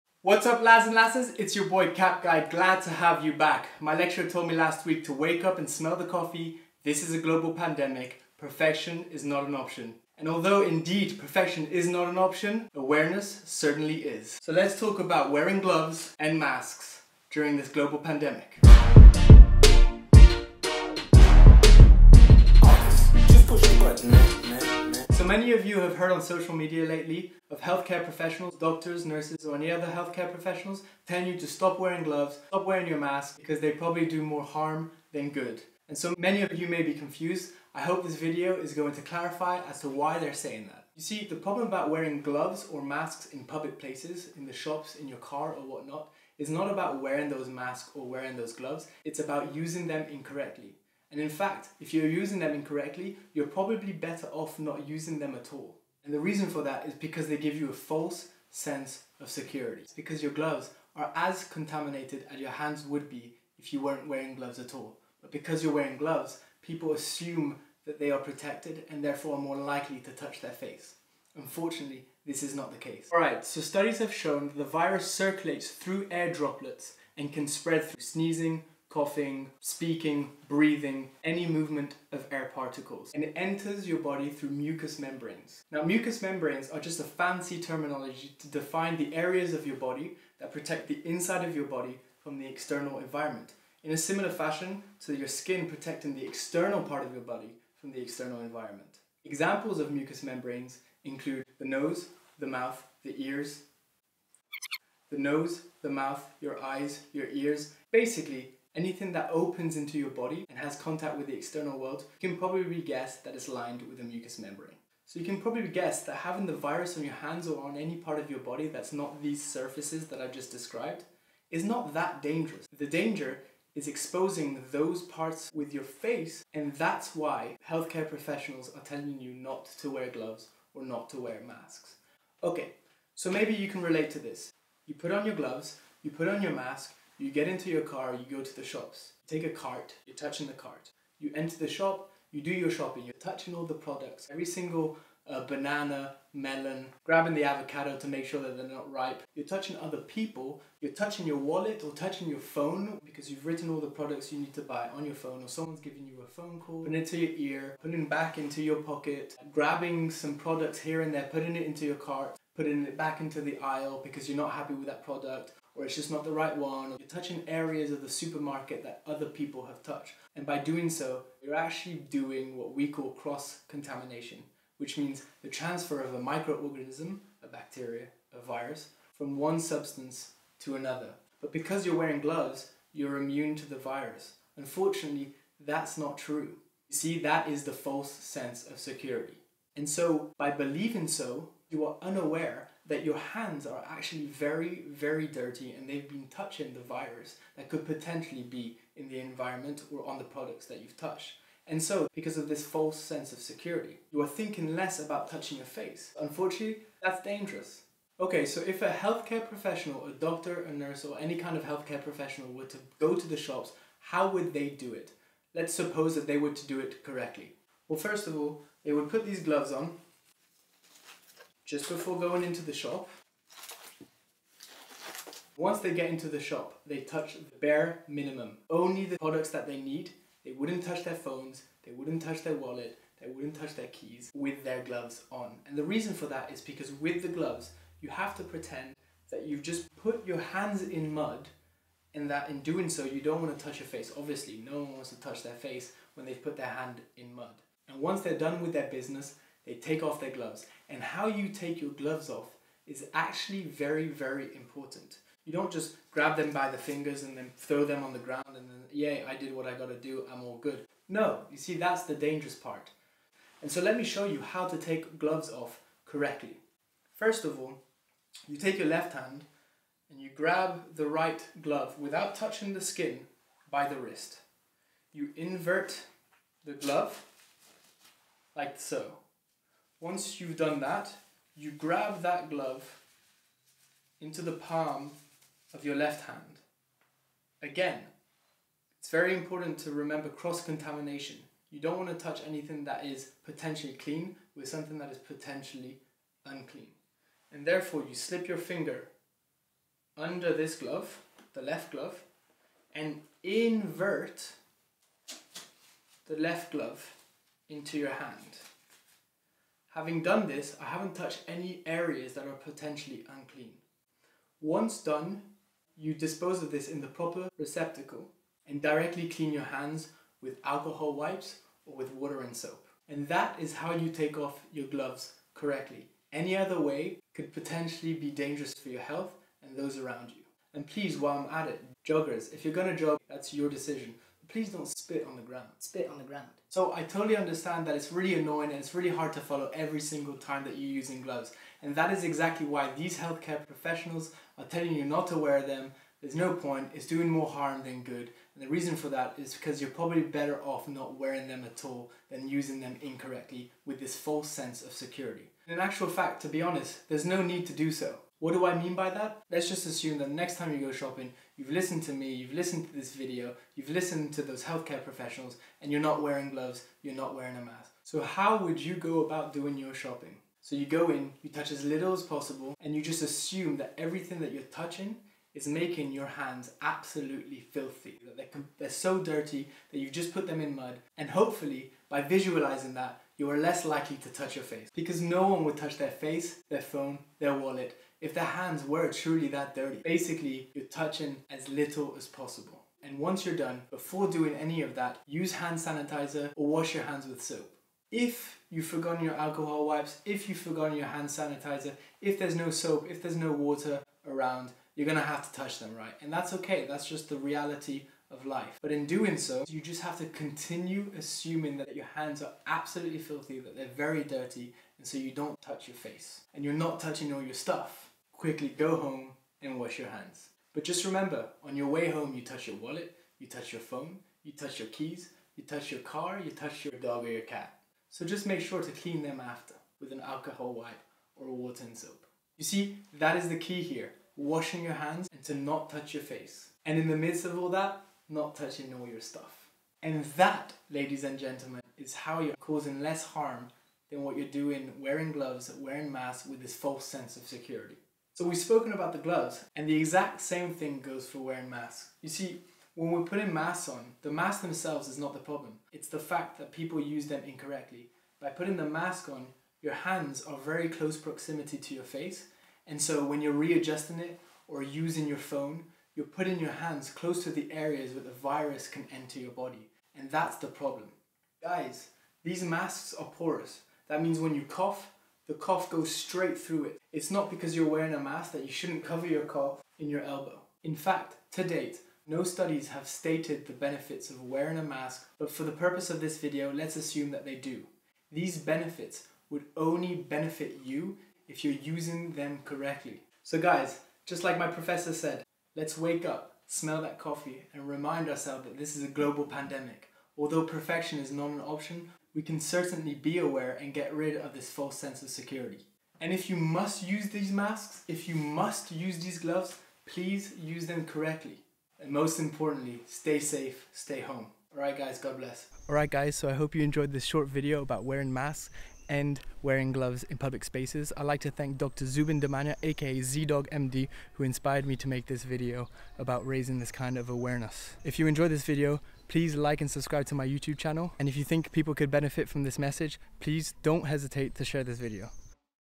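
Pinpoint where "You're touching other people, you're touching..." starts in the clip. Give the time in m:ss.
2:29.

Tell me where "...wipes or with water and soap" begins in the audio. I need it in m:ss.
5:21.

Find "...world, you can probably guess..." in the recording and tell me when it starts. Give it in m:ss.
1:51.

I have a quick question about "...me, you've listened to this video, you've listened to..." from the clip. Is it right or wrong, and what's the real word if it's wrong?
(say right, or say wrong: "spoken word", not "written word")
right.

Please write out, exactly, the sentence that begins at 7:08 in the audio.
So just make sure to clean them after with an alcohol wipe or water and soap.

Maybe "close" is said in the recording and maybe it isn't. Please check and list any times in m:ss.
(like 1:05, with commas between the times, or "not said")
7:40, 7:47.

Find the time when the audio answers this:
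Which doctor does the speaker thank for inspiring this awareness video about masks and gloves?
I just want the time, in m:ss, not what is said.
8:41.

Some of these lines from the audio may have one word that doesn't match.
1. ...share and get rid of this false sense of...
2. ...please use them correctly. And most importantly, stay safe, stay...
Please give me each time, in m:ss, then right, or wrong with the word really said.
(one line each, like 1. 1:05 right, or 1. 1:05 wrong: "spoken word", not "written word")
1. 8:23 wrong: "aware", not "share"
2. 8:30 right.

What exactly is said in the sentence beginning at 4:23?
And so let me show you how to take gloves off correctly.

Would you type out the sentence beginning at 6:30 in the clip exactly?
Basically, you're touching as little as possible.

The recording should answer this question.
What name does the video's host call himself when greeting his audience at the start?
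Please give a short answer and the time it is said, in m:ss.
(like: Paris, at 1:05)
Cap Guy, at 0:01.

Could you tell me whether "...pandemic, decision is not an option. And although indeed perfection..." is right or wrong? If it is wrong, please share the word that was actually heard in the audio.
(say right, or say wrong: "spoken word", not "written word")
wrong: "perfection", not "decision".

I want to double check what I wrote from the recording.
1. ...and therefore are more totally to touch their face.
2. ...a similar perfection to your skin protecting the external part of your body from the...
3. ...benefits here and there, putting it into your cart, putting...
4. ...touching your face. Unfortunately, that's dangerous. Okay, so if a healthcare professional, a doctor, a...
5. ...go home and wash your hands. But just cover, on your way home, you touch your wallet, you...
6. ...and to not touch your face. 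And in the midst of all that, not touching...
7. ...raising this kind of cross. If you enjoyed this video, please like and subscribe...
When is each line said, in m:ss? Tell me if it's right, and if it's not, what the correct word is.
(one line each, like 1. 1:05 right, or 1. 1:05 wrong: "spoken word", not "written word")
1. 1:08 wrong: "likely", not "totally"
2. 1:33 wrong: "fashion", not "perfection"
3. 2:40 wrong: "products", not "benefits"
4. 3:25 right
5. 6:58 wrong: "remember", not "cover"
6. 7:15 right
7. 8:46 wrong: "awareness", not "cross".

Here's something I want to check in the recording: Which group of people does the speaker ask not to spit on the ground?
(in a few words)
joggers.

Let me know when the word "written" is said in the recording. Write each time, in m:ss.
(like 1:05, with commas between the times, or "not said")
2:33.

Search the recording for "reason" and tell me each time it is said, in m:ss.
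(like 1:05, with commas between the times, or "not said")
0:56, 3:55, 5:48.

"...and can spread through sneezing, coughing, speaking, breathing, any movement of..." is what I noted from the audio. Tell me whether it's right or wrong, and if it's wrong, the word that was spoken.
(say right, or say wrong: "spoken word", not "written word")
right.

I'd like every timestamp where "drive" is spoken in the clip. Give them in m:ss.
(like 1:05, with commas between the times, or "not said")
not said.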